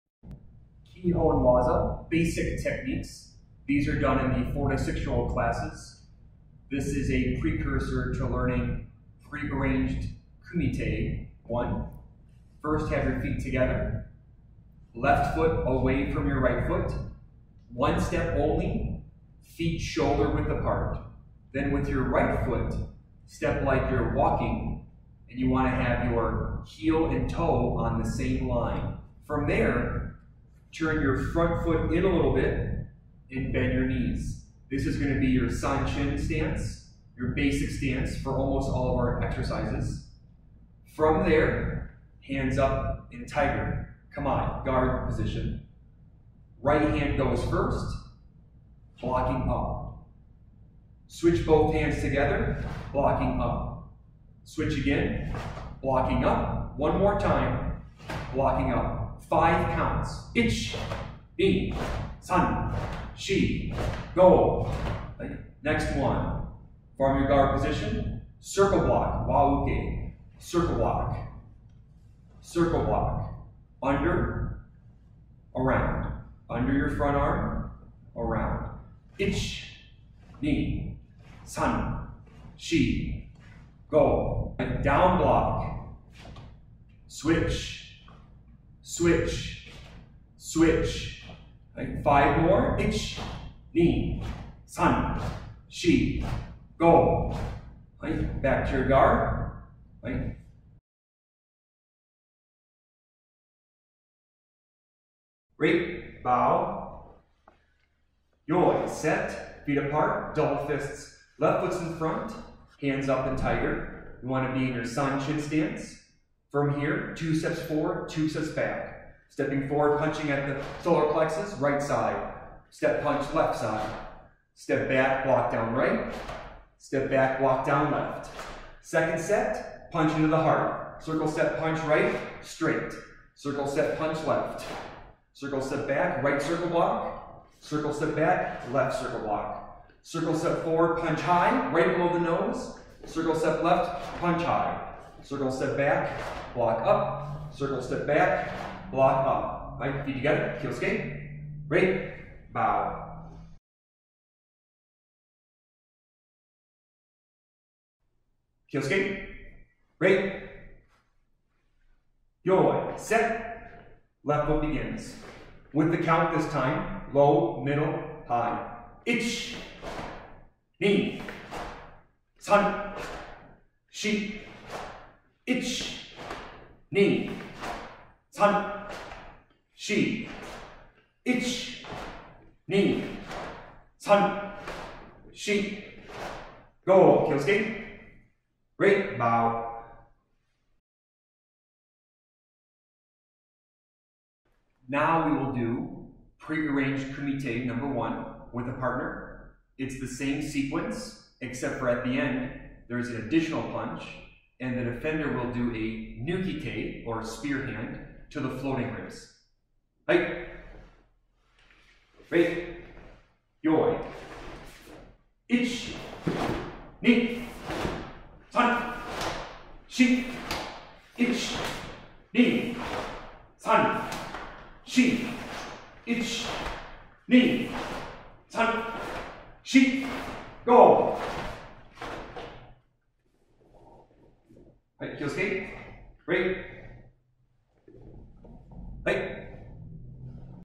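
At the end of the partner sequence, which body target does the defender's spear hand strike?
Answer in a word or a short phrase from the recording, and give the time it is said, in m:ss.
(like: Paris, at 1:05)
Floating ribs, at 3:28.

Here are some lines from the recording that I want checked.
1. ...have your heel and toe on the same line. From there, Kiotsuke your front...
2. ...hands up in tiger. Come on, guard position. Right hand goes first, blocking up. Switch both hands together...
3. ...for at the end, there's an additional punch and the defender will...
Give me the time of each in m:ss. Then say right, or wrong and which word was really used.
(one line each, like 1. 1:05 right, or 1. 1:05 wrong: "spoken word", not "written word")
1. 0:25 wrong: "Turn", not "Kiotsuke"
2. 0:42 right
3. 3:21 right.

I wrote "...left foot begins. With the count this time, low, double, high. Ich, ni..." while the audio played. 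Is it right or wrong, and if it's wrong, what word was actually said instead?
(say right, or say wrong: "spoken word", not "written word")
wrong: "middle", not "double".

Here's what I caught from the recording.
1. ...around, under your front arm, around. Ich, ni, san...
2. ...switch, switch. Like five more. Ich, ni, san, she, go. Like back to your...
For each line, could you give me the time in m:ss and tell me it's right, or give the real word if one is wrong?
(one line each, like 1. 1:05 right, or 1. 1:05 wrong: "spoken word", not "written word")
1. 1:15 right
2. 1:28 right.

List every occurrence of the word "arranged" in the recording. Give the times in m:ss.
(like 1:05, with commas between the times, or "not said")
0:09, 3:16.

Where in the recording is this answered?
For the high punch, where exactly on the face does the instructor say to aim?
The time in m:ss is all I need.
2:21.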